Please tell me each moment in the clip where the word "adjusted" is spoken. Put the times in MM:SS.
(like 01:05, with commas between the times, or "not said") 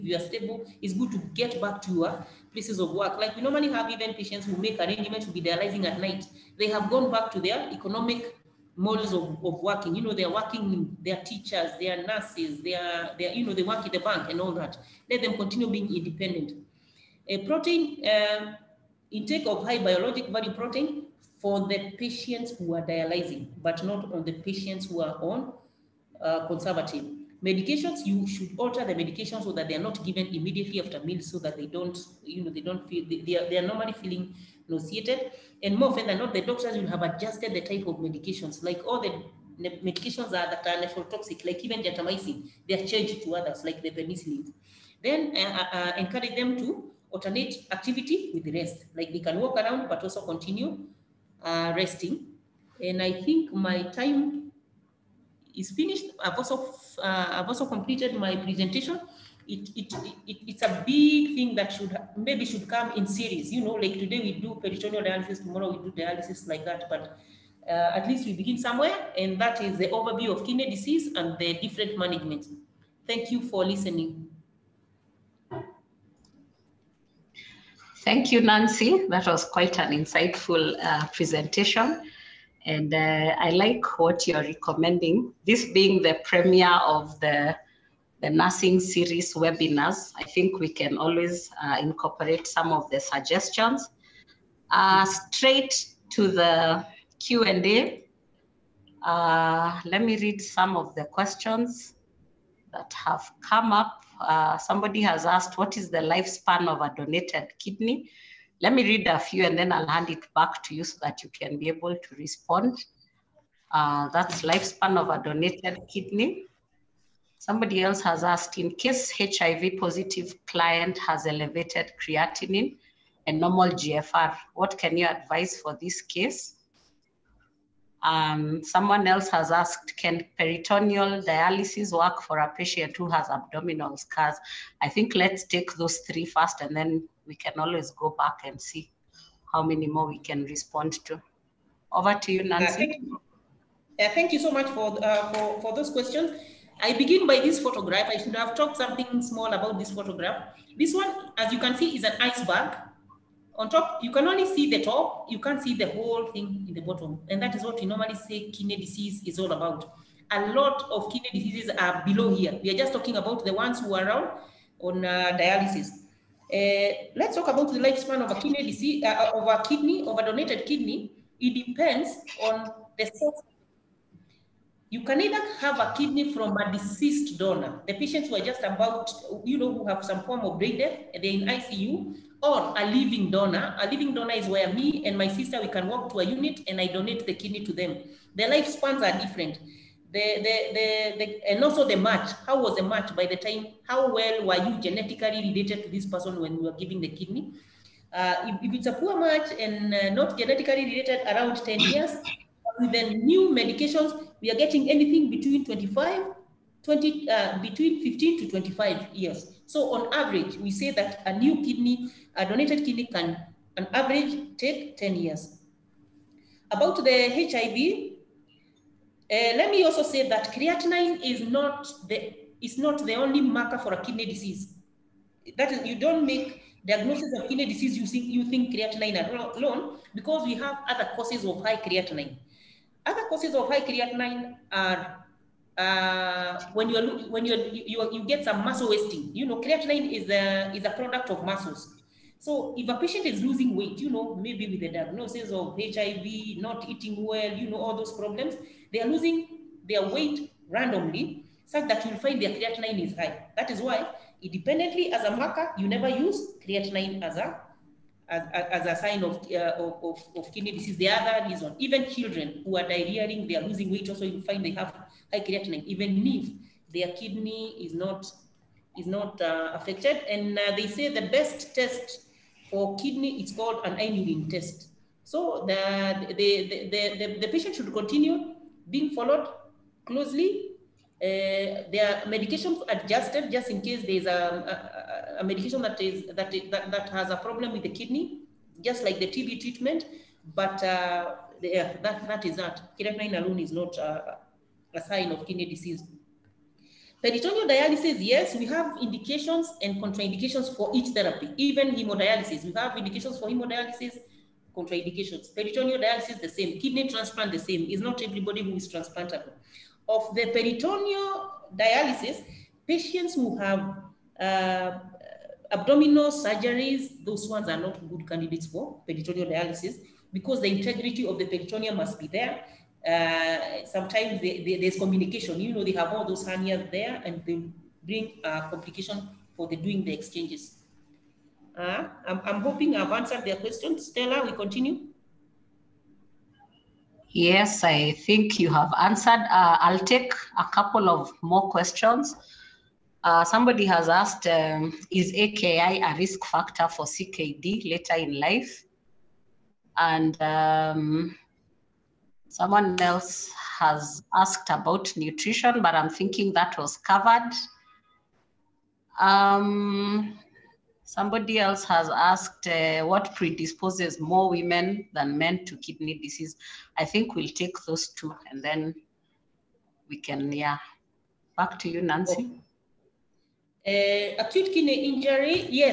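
00:37, 04:42.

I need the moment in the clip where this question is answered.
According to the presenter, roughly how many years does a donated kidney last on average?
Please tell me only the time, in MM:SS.
03:33.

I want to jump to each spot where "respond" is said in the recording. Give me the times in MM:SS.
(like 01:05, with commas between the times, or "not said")
01:52, 02:20.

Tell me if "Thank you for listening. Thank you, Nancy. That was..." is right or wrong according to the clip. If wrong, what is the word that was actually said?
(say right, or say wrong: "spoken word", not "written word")
right.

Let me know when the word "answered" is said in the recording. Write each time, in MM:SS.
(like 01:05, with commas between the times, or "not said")
05:33, 05:39.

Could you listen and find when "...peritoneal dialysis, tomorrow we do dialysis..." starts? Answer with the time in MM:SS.
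01:04.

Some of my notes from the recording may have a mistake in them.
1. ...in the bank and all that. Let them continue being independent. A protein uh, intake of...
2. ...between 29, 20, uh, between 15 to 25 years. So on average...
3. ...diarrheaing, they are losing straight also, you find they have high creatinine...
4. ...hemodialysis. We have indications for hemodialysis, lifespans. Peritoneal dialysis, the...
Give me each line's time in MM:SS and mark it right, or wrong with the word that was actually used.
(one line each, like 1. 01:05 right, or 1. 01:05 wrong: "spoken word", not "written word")
1. 00:13 right
2. 03:25 wrong: "25", not "29"
3. 04:22 wrong: "weight", not "straight"
4. 05:01 wrong: "contraindications", not "lifespans".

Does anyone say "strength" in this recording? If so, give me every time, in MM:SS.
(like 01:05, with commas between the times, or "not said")
not said.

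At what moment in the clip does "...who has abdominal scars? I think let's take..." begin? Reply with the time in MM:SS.
02:12.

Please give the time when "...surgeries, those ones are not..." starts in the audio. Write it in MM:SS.
05:16.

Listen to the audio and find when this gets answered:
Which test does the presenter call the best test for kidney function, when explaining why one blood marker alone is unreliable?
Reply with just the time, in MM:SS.
04:33.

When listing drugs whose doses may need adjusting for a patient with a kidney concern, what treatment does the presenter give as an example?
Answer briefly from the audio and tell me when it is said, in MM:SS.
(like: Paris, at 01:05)
TB treatment, at 04:49.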